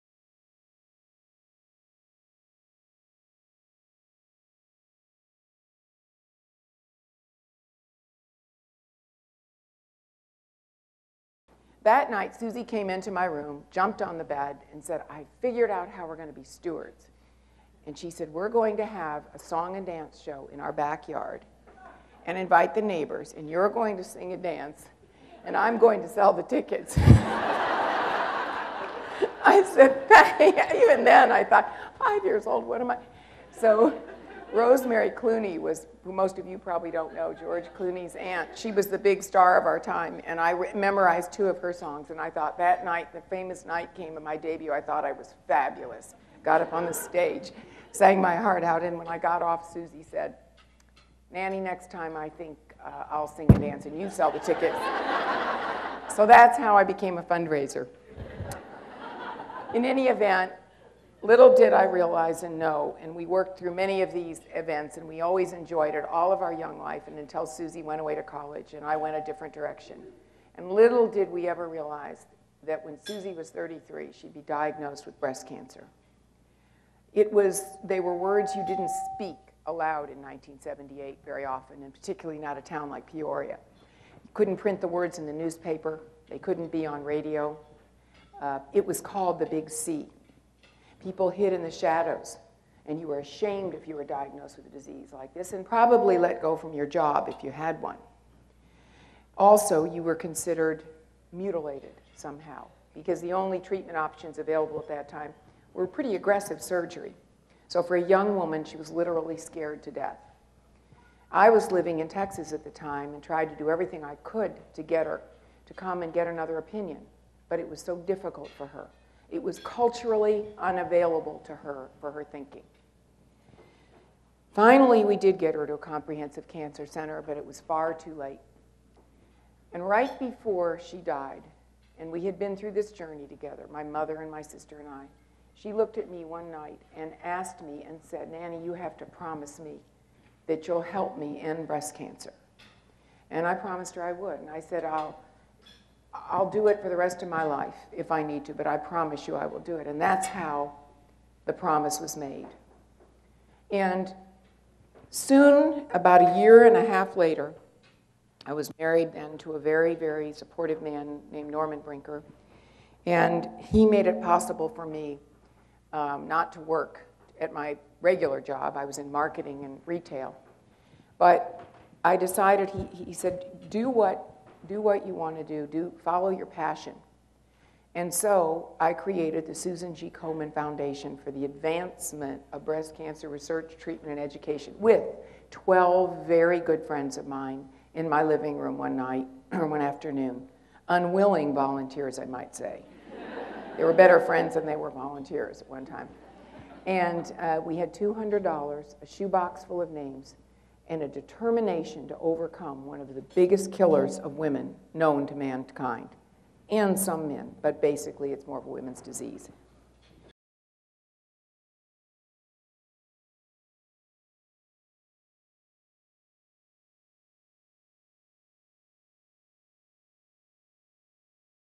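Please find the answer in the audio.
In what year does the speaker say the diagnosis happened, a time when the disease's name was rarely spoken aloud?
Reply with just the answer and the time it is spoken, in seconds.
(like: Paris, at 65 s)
1978, at 80 s.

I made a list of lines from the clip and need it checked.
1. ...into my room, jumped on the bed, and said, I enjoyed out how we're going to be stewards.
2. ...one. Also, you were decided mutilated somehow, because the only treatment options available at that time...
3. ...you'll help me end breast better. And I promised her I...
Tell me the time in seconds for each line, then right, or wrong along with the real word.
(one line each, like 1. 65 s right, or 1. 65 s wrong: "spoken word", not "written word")
1. 12 s wrong: "figured", not "enjoyed"
2. 97 s wrong: "considered", not "decided"
3. 140 s wrong: "cancer", not "better".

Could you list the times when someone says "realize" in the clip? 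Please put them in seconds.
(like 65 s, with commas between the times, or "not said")
61 s, 71 s.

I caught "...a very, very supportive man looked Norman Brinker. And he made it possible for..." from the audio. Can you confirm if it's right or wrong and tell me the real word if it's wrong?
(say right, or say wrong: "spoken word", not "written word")
wrong: "named", not "looked".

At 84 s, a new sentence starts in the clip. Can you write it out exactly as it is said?
You couldn't print the words in the newspaper, they couldn't be on radio.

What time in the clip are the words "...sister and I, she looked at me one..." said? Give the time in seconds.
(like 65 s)
134 s.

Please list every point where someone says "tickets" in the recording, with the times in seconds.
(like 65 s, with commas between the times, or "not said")
26 s, 54 s.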